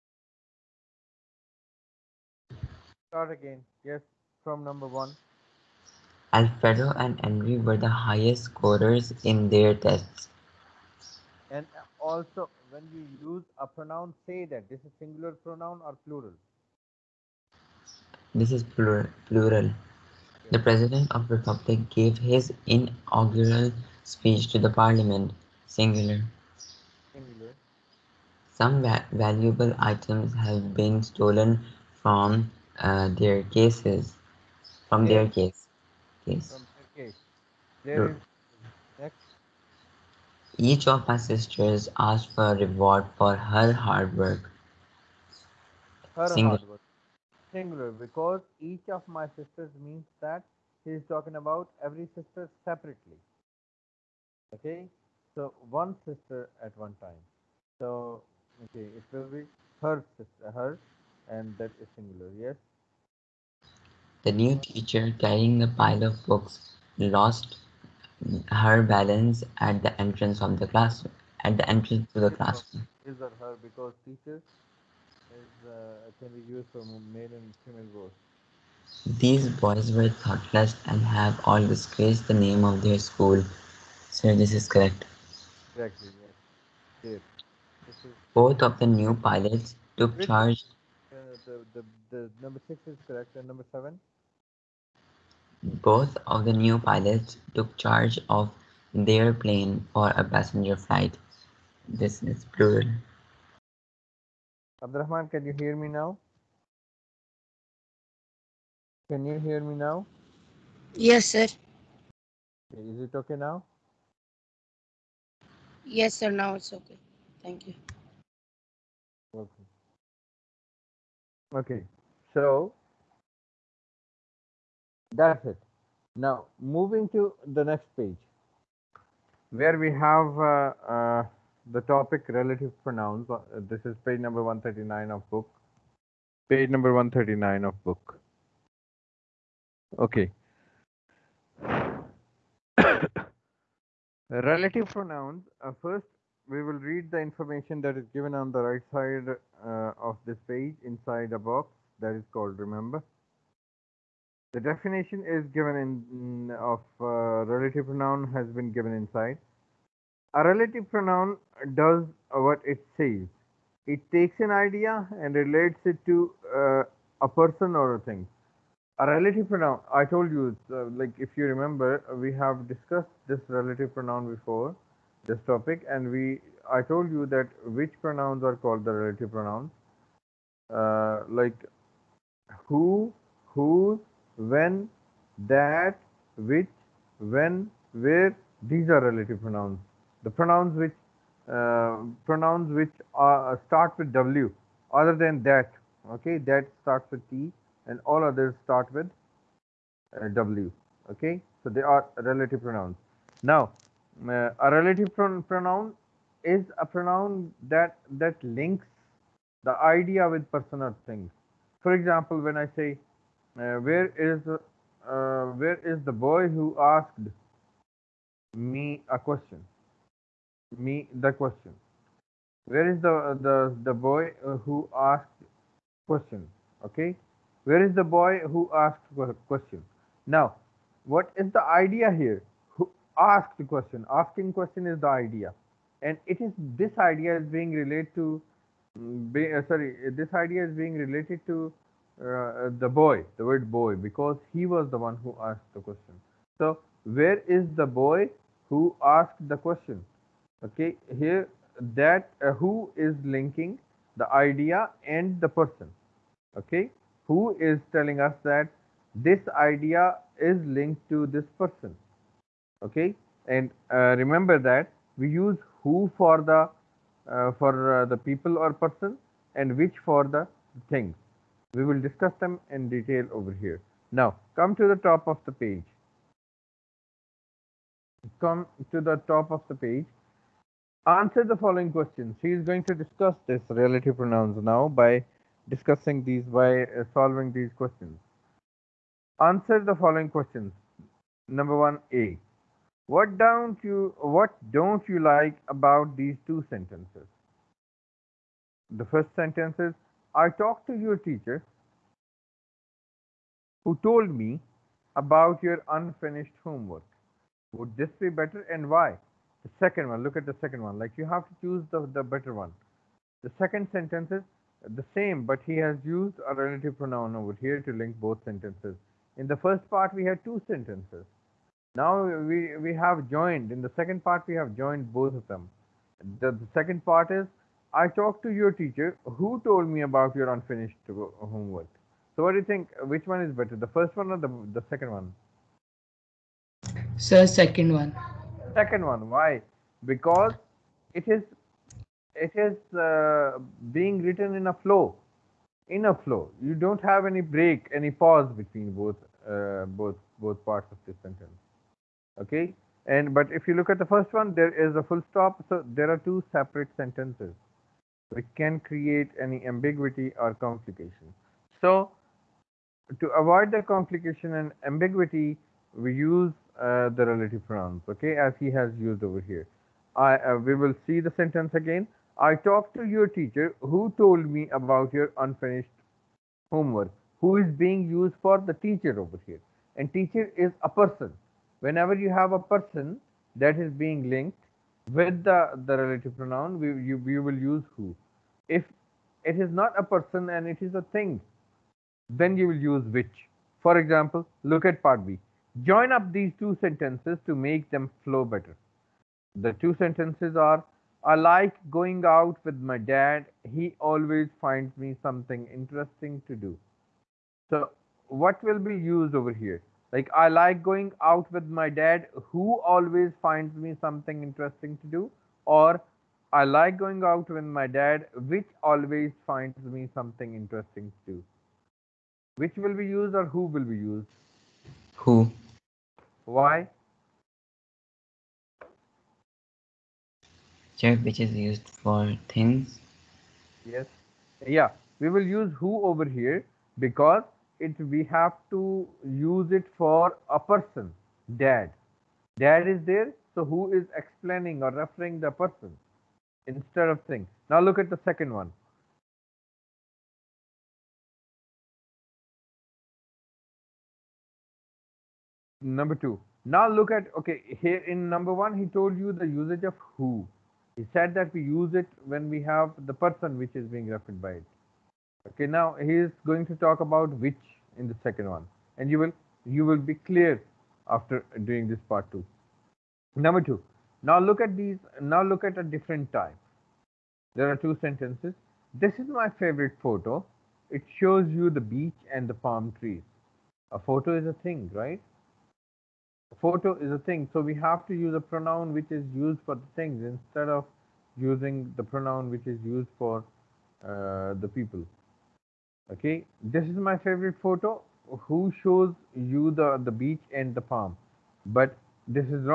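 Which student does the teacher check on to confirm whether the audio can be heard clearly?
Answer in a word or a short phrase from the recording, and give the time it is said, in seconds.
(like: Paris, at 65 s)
Abdurrahman, at 104 s.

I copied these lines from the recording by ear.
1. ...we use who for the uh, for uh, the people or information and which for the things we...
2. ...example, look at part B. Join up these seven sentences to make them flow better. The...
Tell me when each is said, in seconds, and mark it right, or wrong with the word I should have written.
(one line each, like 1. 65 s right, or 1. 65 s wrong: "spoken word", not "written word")
1. 265 s wrong: "person", not "information"
2. 393 s wrong: "two", not "seven".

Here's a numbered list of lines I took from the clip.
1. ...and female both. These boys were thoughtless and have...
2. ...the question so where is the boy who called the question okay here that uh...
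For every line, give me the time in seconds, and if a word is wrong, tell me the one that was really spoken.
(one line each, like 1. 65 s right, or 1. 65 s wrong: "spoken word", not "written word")
1. 77 s right
2. 245 s wrong: "asked", not "called".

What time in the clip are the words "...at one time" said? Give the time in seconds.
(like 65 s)
56 s.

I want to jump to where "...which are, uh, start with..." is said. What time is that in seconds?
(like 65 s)
192 s.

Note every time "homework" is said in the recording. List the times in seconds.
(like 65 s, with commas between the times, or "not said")
306 s, 331 s, 376 s.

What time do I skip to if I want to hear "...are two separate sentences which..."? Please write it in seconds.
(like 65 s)
356 s.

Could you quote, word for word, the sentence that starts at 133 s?
Uh, this is page number 139 of book.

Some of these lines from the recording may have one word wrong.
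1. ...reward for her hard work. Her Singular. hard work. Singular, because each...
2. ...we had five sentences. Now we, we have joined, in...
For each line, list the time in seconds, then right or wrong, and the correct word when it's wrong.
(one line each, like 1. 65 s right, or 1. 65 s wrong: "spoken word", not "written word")
1. 42 s right
2. 320 s wrong: "two", not "five".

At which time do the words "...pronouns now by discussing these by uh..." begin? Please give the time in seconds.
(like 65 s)
284 s.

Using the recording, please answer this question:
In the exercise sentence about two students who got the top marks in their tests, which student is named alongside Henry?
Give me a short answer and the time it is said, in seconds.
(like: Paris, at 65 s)
Alfredo, at 6 s.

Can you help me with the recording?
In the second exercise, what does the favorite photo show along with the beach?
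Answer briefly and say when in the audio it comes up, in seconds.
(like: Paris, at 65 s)
palm trees, at 482 s.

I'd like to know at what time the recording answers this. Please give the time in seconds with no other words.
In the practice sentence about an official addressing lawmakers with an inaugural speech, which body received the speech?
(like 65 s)
24 s.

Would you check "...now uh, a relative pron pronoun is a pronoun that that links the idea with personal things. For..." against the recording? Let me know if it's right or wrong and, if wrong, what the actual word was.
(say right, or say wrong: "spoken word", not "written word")
right.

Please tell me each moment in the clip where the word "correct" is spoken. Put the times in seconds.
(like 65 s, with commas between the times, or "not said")
84 s, 93 s.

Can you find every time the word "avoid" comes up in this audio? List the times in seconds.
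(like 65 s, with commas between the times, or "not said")
363 s.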